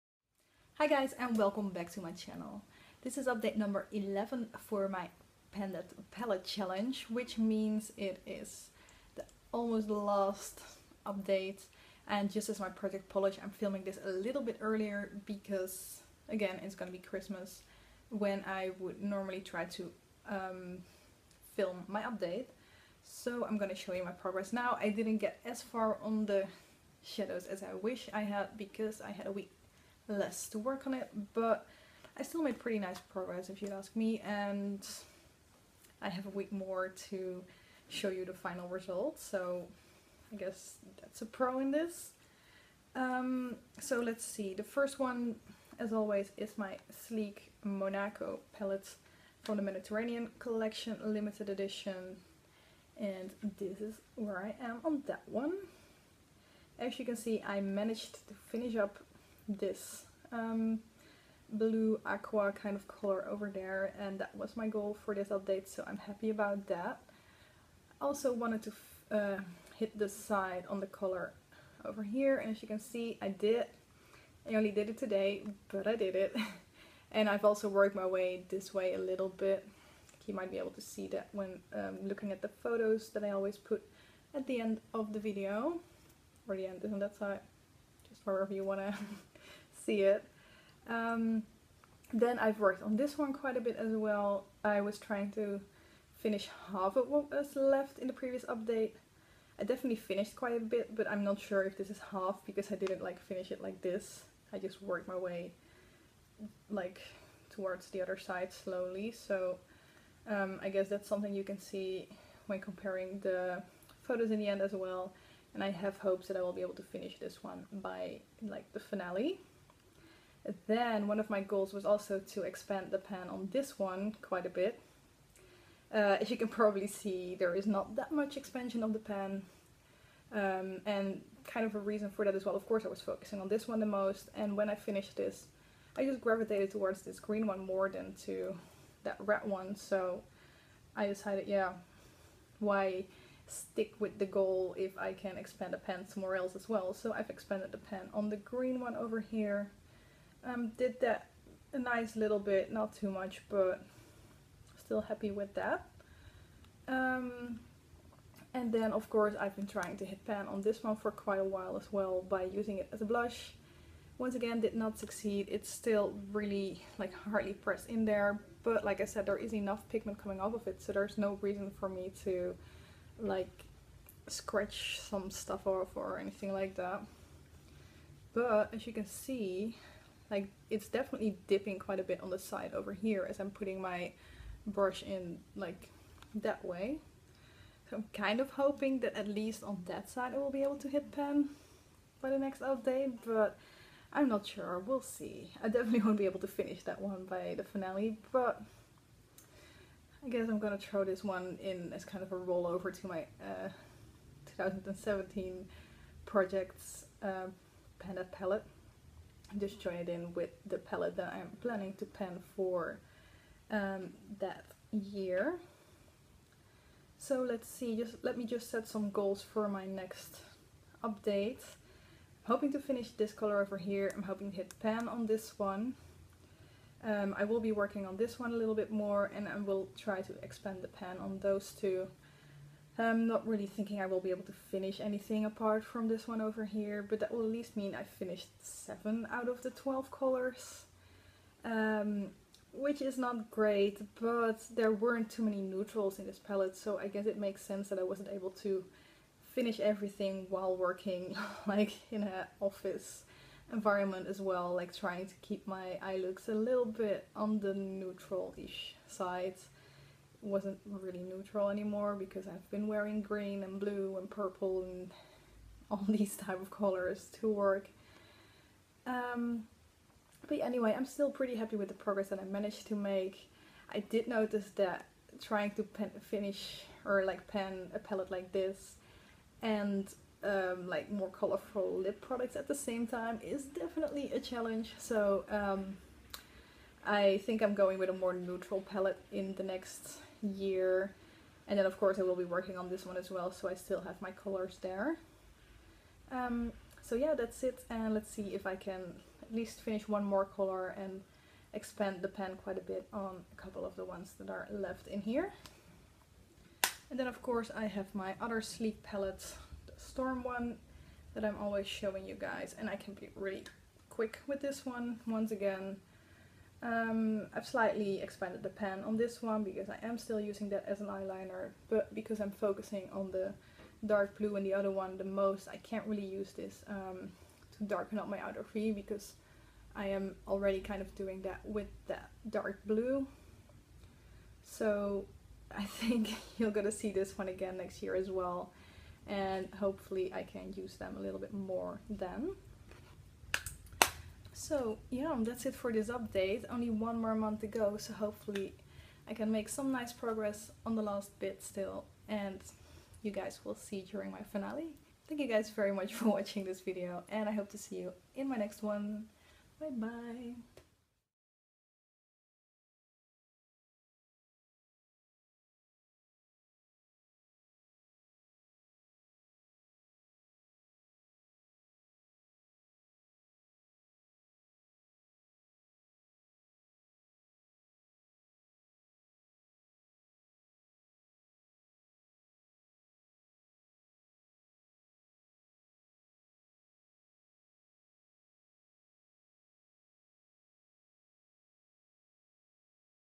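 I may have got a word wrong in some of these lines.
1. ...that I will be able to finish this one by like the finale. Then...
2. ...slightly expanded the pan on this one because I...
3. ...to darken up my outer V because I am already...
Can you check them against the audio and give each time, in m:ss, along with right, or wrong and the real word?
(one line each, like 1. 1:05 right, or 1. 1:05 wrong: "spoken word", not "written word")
1. 1:56 right
2. 5:17 right
3. 5:27 right.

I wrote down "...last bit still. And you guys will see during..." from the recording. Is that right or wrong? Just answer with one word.
right.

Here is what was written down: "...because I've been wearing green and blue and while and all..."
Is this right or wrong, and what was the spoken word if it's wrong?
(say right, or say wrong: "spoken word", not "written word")
wrong: "purple", not "while".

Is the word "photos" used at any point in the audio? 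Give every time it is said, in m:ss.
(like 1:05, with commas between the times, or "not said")
1:22, 1:54.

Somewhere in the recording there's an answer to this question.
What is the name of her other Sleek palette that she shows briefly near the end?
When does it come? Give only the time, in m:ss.
5:09.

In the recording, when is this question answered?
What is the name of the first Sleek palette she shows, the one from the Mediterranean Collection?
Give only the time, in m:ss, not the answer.
0:47.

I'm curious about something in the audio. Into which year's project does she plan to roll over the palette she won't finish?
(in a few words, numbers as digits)
2017.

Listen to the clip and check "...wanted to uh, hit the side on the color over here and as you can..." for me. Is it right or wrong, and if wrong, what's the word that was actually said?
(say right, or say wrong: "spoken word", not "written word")
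right.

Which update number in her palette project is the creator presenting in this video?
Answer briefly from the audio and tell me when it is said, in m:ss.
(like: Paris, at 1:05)
11, at 0:03.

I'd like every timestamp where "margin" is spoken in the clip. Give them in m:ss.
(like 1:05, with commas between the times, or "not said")
not said.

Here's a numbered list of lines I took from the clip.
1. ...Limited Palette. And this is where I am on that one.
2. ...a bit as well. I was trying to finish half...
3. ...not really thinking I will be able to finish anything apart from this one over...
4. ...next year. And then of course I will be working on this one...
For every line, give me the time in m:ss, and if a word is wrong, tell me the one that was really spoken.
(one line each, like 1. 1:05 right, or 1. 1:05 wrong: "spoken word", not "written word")
1. 0:51 wrong: "Edition", not "Palette"
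2. 1:33 right
3. 3:53 right
4. 4:49 right.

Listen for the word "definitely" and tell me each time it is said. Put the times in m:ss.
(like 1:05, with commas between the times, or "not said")
1:39, 3:00, 3:15, 4:43.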